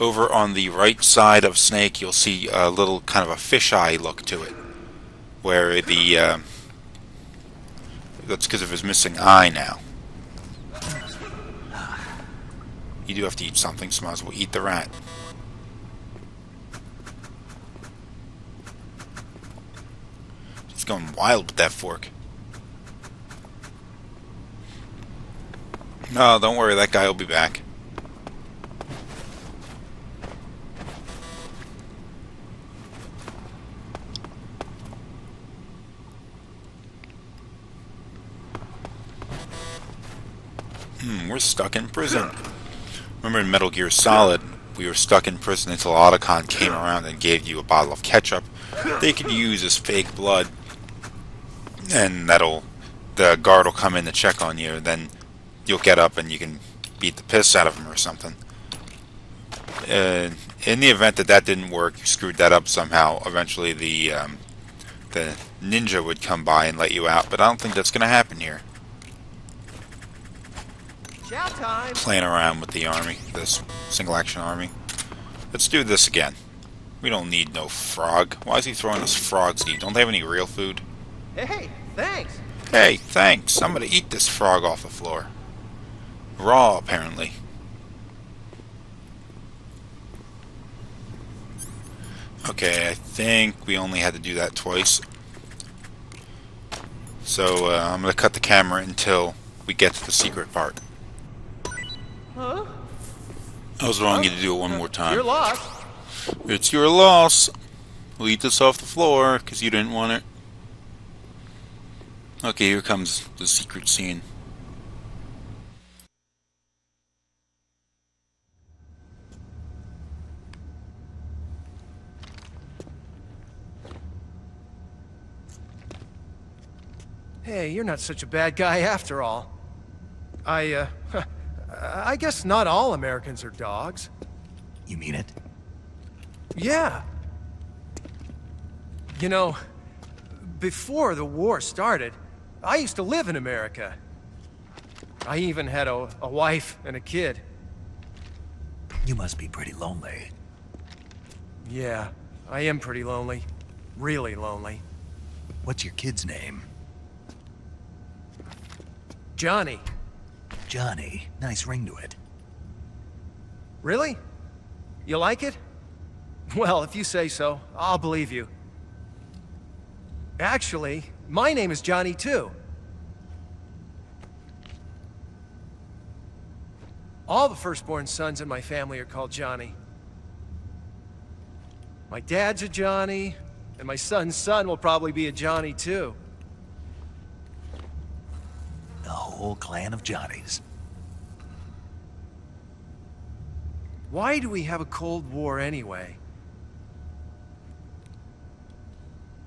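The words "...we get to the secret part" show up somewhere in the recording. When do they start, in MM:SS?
01:39.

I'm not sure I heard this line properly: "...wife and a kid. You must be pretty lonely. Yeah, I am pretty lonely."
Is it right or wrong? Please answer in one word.
right.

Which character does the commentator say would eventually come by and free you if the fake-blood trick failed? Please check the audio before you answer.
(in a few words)
The ninja.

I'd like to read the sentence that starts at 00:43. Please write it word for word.
Remember in Metal Gear Solid, we were stuck in prison until Otacon came around and gave you a bottle of ketchup.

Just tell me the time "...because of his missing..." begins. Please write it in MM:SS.
00:08.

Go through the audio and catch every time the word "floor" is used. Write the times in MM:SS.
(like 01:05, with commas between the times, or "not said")
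01:24, 01:48.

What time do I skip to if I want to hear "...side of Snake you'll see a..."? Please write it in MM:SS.
00:01.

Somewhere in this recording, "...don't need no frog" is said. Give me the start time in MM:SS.
01:17.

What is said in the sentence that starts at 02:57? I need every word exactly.
All the firstborn sons in my family are called Johnny.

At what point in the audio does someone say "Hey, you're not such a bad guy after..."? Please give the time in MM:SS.
02:07.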